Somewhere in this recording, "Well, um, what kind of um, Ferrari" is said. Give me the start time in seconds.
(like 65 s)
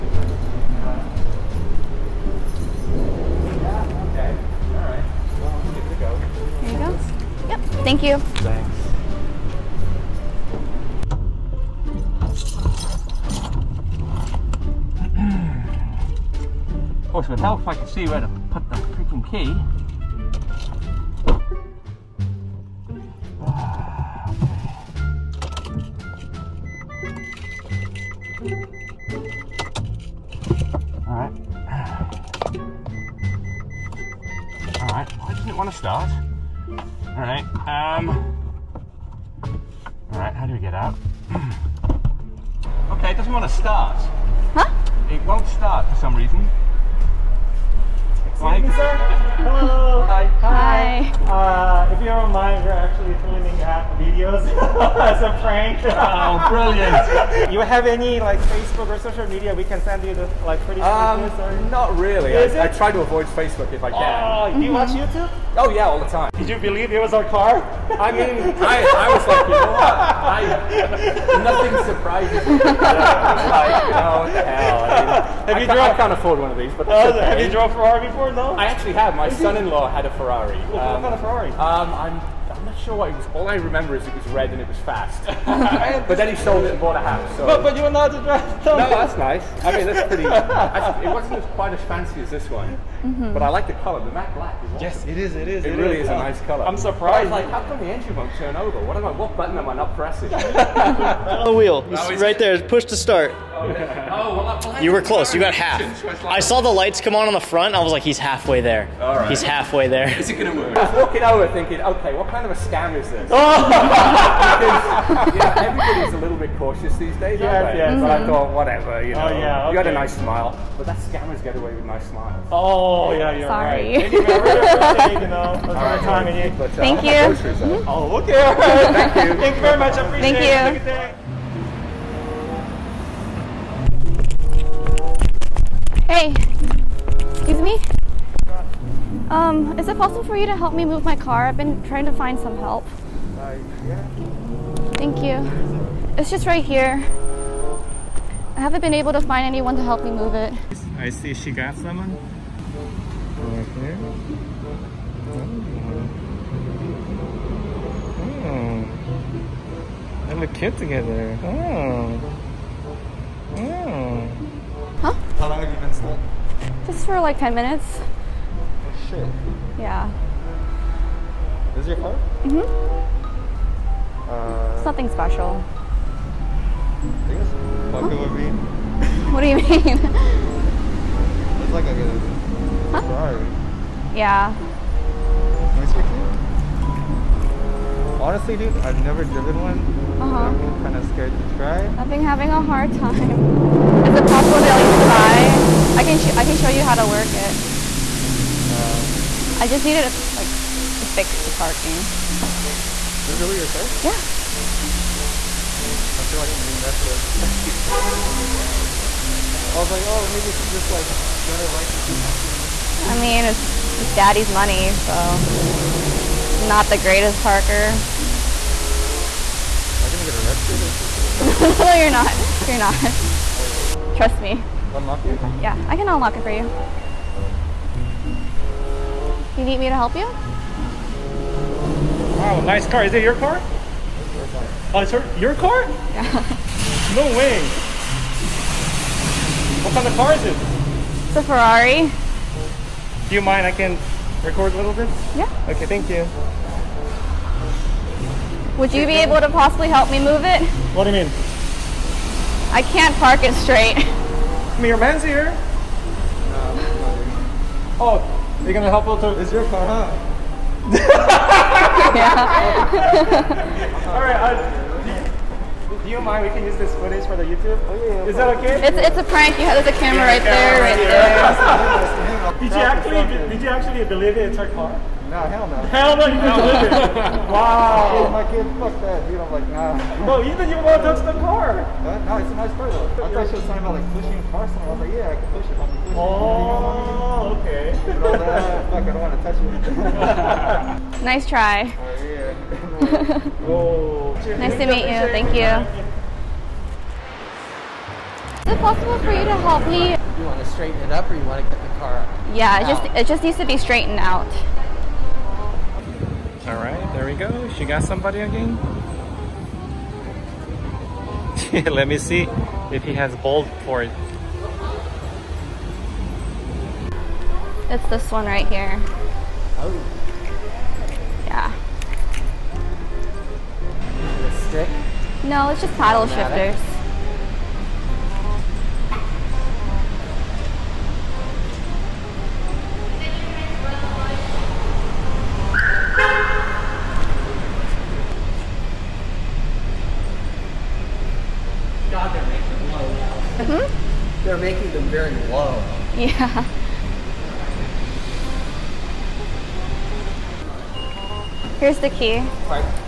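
80 s.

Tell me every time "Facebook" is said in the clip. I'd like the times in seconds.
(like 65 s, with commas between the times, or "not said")
58 s, 63 s.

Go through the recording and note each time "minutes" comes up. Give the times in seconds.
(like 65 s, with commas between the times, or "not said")
167 s.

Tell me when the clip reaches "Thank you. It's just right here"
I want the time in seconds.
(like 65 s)
144 s.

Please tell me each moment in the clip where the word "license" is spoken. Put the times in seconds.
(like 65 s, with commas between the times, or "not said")
211 s.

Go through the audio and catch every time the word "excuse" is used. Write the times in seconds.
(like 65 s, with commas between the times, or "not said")
137 s.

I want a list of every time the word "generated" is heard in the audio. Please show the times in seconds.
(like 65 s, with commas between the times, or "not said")
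not said.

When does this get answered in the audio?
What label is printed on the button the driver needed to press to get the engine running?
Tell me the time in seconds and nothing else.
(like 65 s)
102 s.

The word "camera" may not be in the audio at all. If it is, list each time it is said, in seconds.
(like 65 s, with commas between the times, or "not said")
270 s.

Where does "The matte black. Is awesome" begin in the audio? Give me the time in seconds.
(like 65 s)
94 s.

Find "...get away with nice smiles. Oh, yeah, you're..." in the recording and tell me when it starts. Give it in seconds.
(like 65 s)
121 s.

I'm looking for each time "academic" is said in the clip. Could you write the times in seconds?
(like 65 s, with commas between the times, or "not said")
not said.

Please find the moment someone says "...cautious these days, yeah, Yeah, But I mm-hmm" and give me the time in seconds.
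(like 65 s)
116 s.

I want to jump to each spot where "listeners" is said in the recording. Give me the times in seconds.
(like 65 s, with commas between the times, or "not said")
not said.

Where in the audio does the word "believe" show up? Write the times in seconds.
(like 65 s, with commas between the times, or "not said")
66 s, 274 s.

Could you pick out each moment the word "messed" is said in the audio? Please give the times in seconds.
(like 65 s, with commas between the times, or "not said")
206 s.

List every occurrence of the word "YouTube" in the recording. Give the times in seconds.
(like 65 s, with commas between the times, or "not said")
64 s, 267 s.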